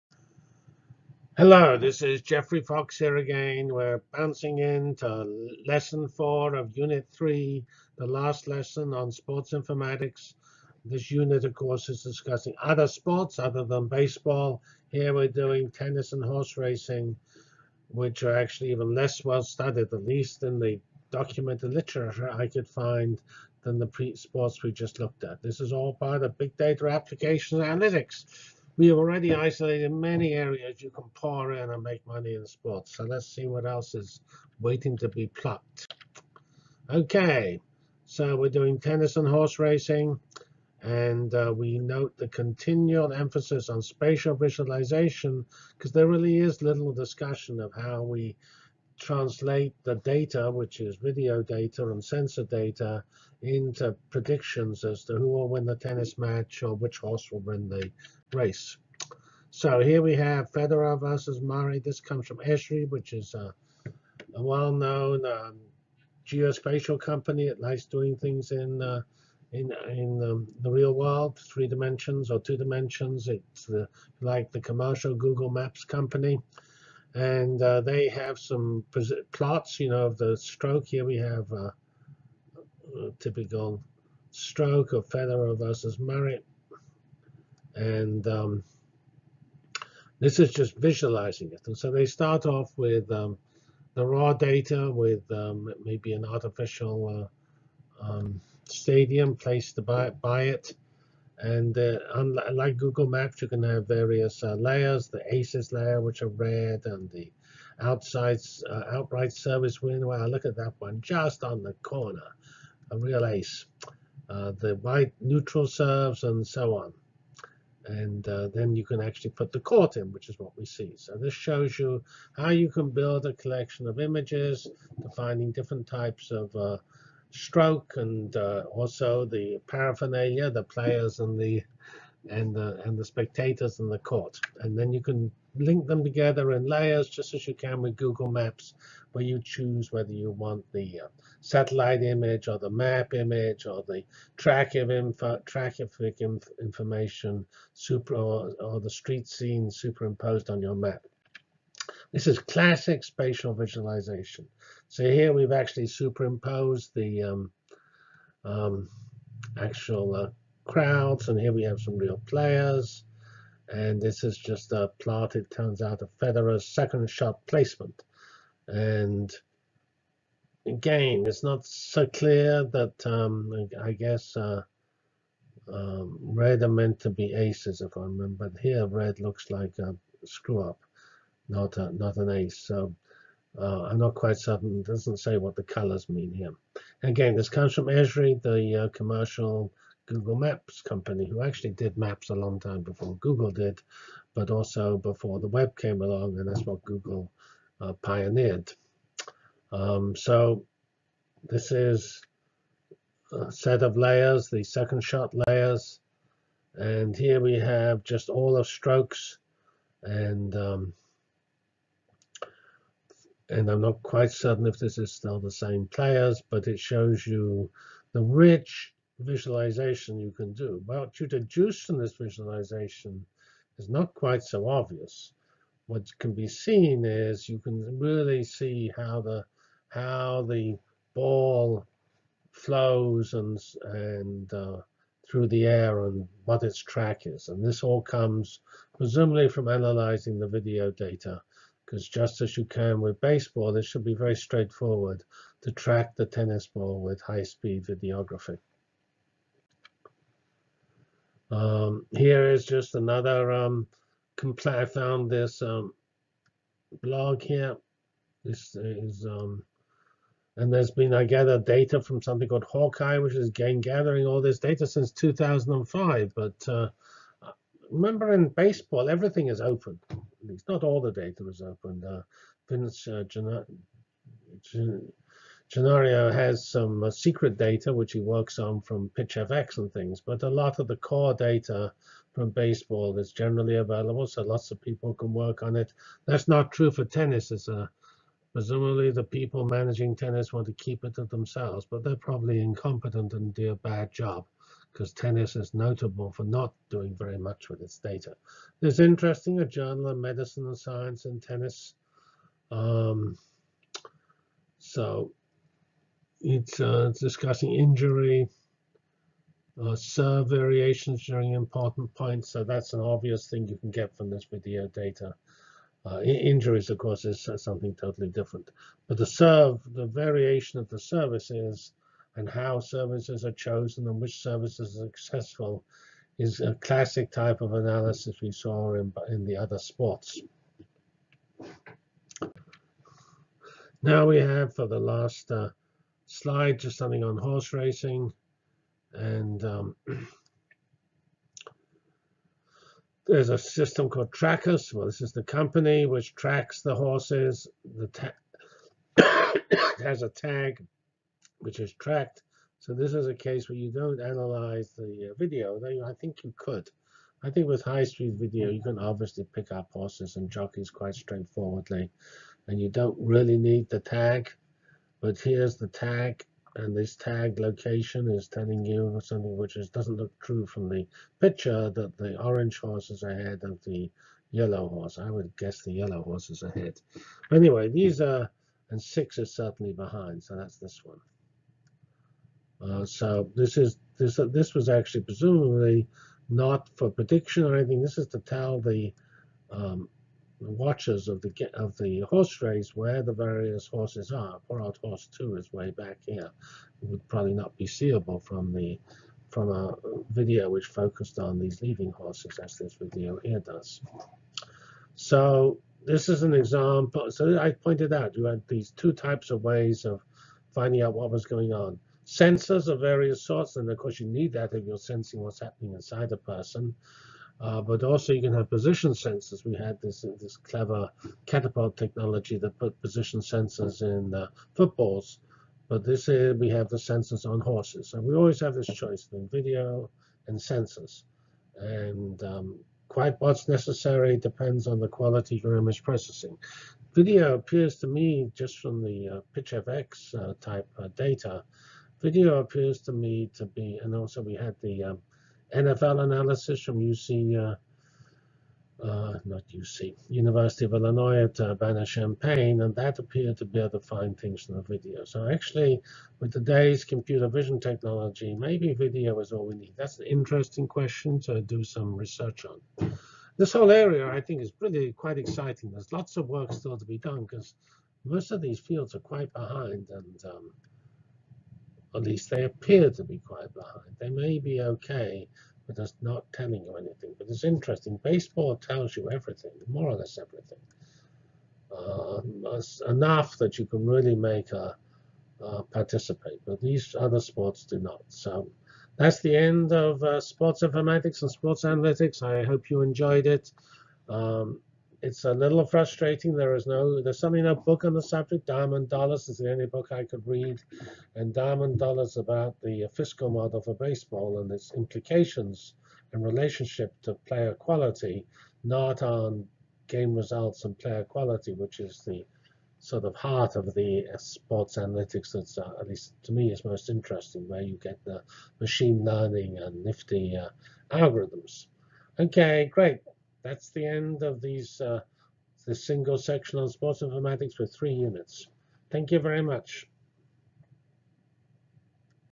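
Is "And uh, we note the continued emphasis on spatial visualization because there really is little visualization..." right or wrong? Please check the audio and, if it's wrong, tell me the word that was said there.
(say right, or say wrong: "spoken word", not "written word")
wrong: "discussion", not "visualization".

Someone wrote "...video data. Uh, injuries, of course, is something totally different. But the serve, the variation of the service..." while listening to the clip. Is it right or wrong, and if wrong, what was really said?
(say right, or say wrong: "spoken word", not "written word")
right.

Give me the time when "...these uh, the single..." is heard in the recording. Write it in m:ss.
8:44.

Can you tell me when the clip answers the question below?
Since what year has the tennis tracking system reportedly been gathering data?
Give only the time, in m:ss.
4:25.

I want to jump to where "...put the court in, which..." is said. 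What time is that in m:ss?
1:59.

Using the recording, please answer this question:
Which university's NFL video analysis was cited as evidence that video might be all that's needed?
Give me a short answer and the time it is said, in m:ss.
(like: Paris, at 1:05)
University of Illinois at Urbana-Champaign, at 7:30.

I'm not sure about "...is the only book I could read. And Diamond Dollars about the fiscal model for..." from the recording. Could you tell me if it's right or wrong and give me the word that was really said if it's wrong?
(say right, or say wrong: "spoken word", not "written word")
right.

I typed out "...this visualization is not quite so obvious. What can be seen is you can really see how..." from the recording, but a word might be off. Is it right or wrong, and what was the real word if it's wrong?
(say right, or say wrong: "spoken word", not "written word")
right.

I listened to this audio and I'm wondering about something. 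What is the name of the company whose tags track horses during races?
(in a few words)
Trackers.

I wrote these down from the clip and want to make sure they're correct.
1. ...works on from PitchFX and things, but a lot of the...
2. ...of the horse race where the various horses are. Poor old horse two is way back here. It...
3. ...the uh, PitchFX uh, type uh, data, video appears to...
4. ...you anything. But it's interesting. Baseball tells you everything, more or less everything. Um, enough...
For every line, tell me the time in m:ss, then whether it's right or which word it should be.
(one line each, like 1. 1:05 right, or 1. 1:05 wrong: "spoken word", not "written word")
1. 4:38 right
2. 6:31 right
3. 7:19 right
4. 7:56 right.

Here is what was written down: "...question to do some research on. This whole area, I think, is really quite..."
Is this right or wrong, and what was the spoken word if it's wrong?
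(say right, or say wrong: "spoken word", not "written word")
right.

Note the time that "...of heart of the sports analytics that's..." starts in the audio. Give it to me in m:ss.
8:33.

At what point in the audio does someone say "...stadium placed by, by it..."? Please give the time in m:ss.
1:38.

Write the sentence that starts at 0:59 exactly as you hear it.
So here we have Federer versus Murray.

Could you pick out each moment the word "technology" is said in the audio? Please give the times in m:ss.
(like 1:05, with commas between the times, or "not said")
7:01, 7:37.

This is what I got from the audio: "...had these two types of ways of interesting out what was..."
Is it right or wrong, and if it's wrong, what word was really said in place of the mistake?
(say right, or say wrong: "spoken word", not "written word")
wrong: "finding", not "interesting".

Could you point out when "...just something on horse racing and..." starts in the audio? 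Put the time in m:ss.
5:36.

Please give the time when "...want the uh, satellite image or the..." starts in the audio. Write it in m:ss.
2:20.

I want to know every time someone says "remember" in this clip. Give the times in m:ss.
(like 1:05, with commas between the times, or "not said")
2:58, 4:27.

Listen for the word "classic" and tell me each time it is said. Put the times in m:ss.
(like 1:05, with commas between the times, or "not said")
2:32, 5:26.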